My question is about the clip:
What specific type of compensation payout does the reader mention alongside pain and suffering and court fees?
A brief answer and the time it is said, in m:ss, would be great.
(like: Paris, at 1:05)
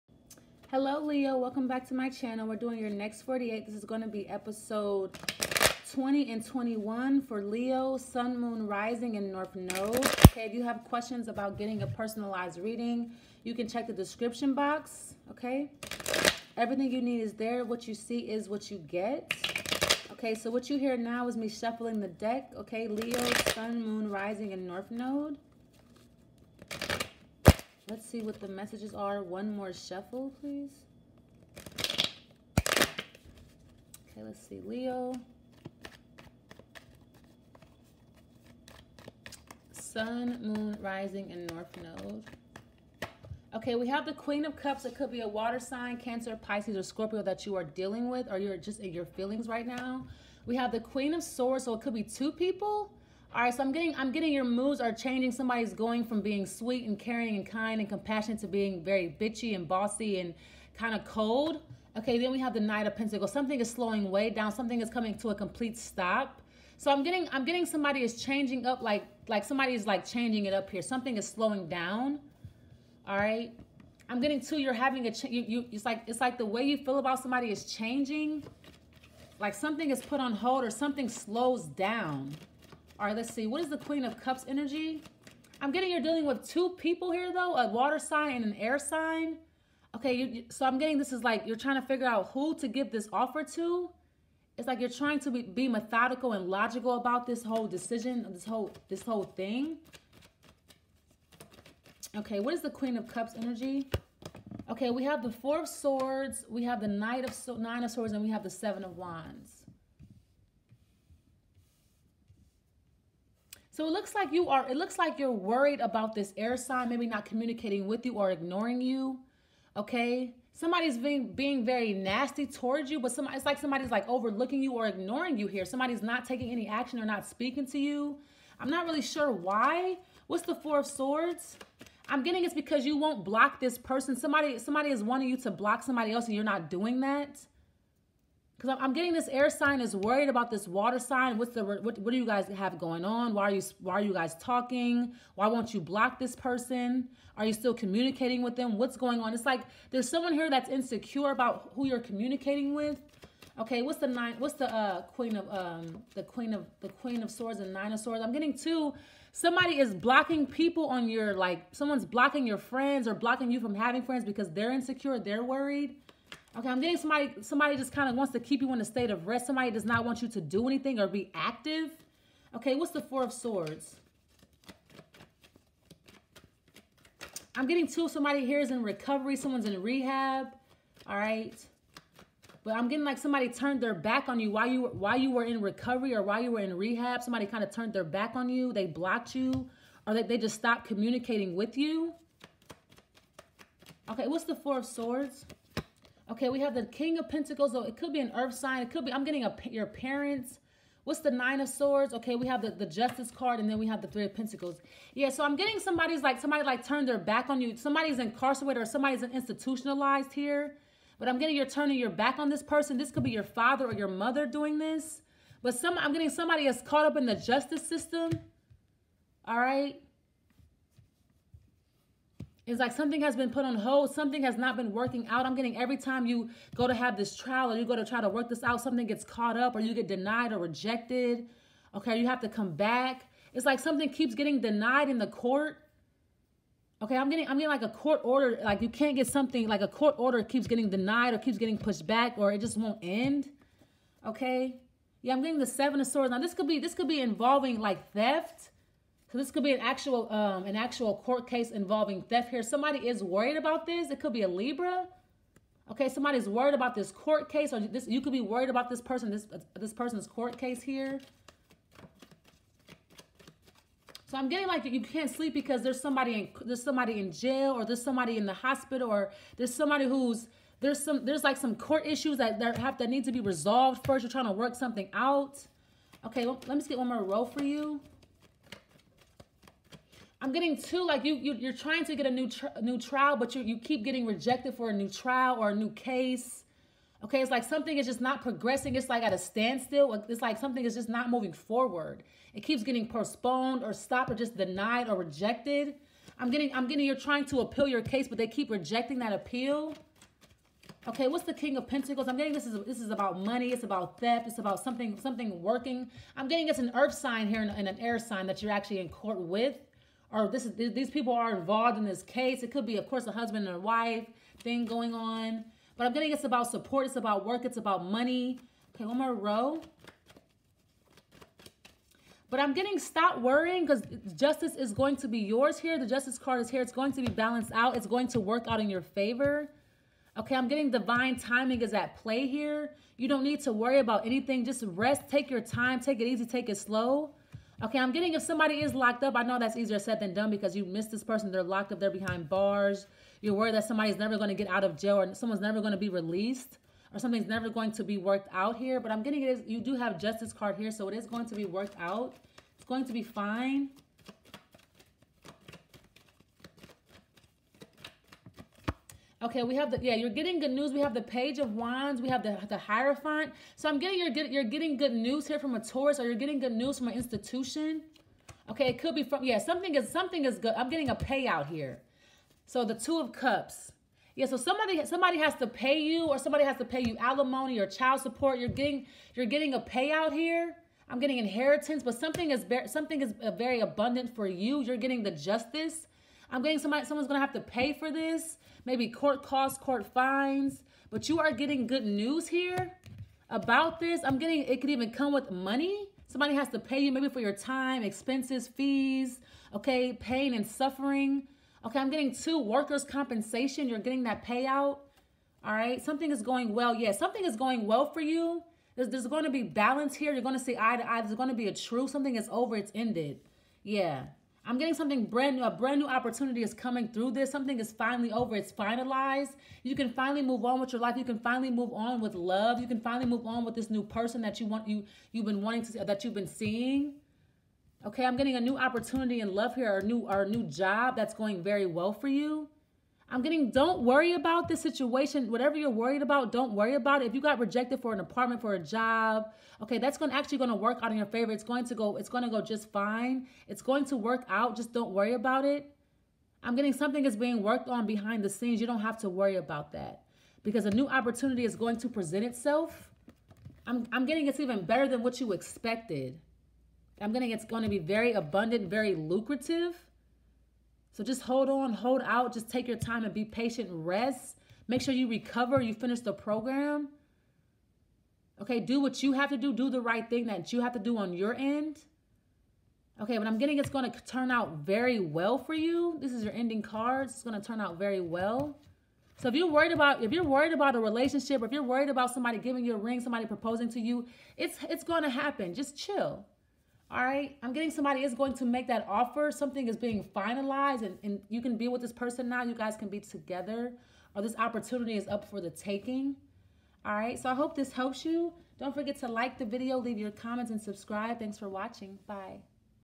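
workers' compensation, at 6:42.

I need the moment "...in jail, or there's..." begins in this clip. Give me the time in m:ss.
4:27.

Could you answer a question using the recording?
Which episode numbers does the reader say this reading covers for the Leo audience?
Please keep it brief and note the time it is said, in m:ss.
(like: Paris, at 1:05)
20 and 21, at 0:04.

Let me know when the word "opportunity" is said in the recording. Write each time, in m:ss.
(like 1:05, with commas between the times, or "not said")
6:56, 7:08, 7:31, 8:14.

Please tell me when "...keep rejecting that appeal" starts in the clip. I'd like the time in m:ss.
4:58.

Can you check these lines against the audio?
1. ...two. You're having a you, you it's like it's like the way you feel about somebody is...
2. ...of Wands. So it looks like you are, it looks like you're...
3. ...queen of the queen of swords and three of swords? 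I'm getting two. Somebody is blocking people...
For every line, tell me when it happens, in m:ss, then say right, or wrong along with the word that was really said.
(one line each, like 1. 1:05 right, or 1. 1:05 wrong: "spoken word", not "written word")
1. 1:14 right
2. 1:48 right
3. 2:36 wrong: "nine", not "three".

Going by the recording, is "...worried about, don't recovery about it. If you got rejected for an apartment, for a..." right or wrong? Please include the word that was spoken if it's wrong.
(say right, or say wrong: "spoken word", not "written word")
wrong: "worry", not "recovery".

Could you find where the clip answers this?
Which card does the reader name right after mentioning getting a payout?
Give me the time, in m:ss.
6:12.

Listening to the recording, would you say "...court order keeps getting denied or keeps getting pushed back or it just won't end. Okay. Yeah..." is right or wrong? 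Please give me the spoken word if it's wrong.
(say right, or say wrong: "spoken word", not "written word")
right.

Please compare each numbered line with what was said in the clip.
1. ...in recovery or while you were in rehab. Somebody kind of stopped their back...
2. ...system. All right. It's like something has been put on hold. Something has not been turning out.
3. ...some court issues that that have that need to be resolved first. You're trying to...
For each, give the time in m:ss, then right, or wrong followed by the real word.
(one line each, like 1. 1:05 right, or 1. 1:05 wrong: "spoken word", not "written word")
1. 3:05 wrong: "turned", not "stopped"
2. 3:37 wrong: "working", not "turning"
3. 4:31 right.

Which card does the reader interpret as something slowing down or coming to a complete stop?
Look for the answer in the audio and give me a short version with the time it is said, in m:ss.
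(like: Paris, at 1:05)
Knight of Pentacles, at 1:02.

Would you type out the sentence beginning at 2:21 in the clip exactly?
What's the what, what do you guys have going on?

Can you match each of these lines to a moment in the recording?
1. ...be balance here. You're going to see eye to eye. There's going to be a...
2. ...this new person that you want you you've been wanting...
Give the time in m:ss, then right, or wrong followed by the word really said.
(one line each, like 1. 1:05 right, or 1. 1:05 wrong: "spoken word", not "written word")
1. 6:49 right
2. 7:03 right.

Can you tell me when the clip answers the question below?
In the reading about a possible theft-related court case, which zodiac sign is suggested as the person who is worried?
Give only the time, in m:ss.
4:14.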